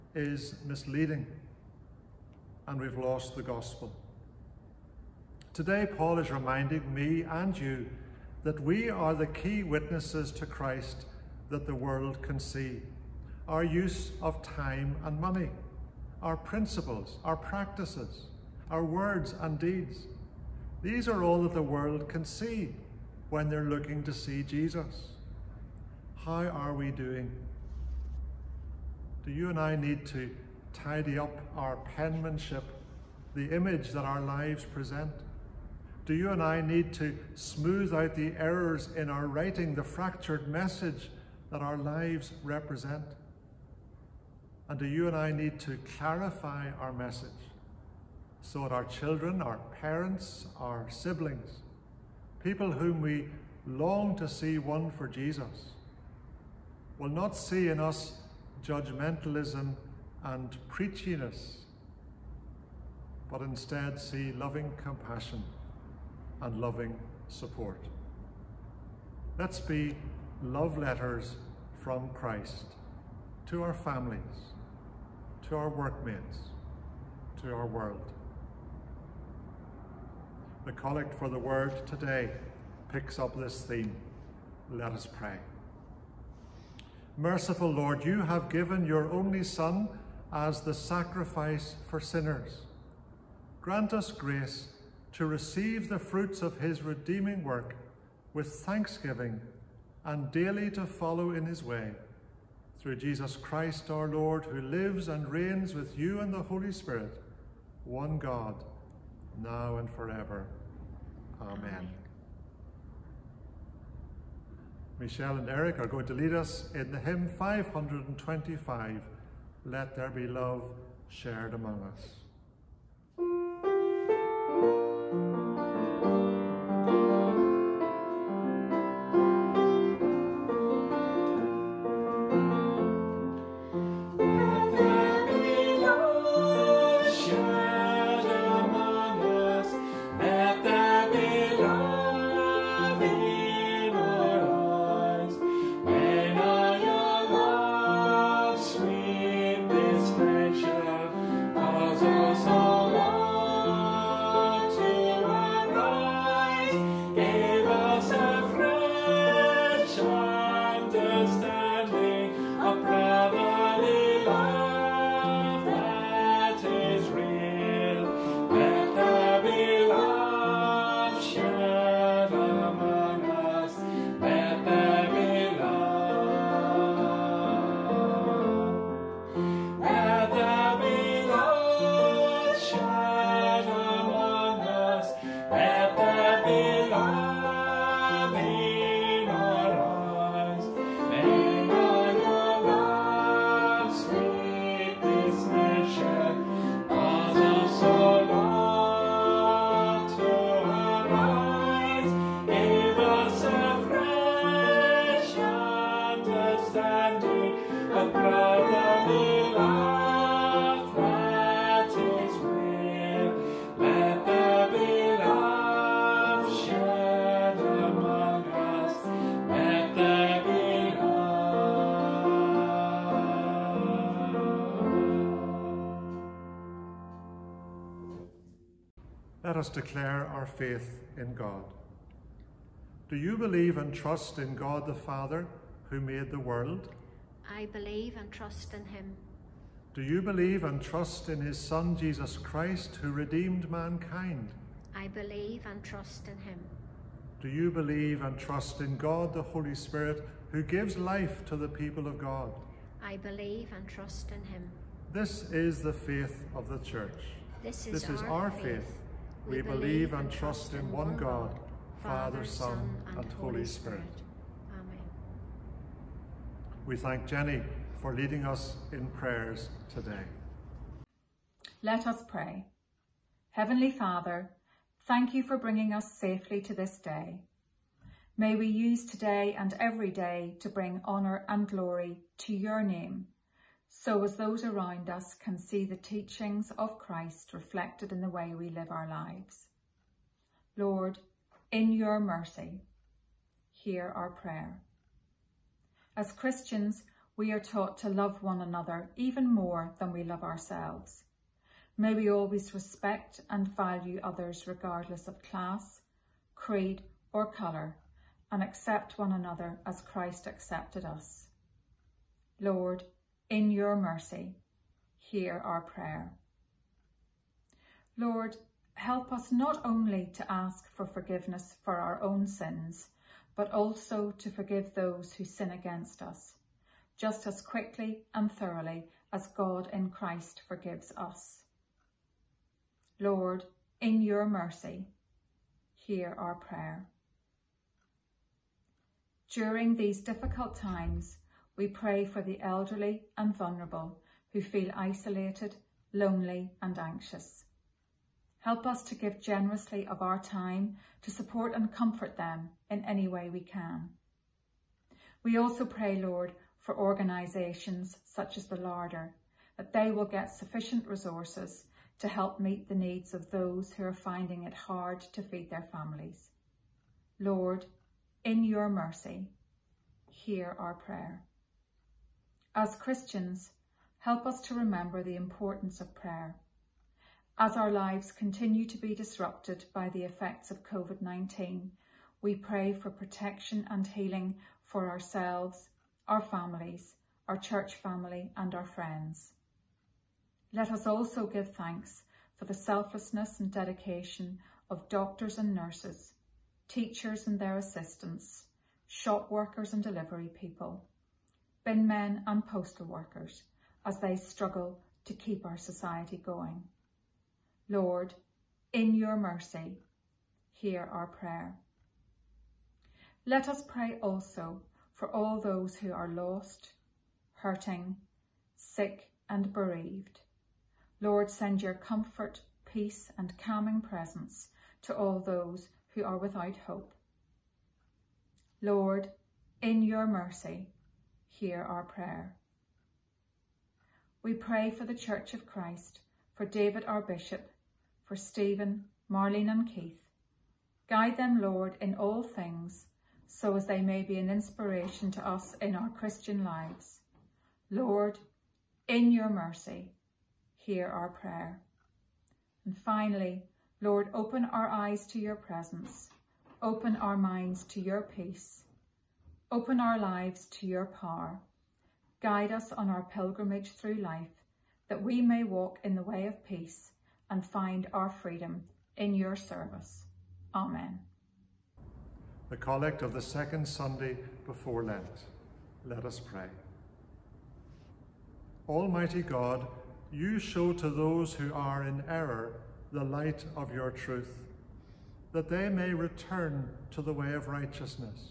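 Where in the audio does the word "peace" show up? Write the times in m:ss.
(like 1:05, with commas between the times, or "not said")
7:02, 7:38, 7:46.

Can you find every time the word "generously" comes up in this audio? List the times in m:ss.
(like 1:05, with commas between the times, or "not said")
5:49.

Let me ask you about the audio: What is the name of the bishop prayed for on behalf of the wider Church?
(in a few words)
David.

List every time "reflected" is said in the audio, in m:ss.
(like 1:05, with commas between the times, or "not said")
4:47.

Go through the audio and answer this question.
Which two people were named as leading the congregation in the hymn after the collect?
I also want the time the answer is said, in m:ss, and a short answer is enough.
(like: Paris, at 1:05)
Michelle and Eric, at 1:54.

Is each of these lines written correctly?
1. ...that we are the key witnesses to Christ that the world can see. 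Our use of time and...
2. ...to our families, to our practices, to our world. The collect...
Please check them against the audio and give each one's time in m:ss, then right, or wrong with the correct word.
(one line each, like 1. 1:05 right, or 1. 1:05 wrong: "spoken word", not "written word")
1. 0:08 right
2. 1:13 wrong: "workmates", not "practices".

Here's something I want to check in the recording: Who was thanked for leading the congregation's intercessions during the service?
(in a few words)
Jenny.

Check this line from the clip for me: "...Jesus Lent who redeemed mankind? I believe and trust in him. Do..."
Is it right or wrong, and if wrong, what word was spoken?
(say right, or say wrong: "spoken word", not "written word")
wrong: "Christ", not "Lent".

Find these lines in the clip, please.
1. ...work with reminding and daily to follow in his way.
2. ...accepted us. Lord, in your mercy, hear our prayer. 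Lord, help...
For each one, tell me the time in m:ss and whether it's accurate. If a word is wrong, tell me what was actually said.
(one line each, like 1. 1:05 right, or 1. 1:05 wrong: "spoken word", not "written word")
1. 1:37 wrong: "thanksgiving", not "reminding"
2. 5:10 right.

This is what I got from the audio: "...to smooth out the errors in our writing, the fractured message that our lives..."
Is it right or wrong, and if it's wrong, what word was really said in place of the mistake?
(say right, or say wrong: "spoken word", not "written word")
right.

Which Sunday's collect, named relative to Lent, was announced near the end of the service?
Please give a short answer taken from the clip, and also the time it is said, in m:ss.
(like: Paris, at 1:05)
Second Sunday before Lent, at 7:53.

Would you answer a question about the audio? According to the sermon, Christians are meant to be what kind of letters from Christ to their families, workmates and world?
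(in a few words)
Love letters.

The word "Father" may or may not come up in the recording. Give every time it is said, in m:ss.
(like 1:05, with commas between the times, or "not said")
3:54, 4:22, 4:33.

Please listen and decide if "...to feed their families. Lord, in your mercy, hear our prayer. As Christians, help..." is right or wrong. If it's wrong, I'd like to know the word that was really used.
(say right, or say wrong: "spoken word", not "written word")
right.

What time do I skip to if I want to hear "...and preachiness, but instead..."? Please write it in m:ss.
1:00.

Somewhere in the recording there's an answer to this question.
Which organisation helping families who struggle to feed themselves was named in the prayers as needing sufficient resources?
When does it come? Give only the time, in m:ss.
5:58.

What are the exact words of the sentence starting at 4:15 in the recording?
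This is the faith of the Church.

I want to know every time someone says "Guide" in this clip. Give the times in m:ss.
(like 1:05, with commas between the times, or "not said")
7:21, 7:42.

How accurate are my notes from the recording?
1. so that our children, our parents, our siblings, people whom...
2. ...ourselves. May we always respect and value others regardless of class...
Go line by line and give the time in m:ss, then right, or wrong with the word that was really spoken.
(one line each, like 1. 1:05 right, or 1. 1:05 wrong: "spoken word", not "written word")
1. 0:48 right
2. 5:00 right.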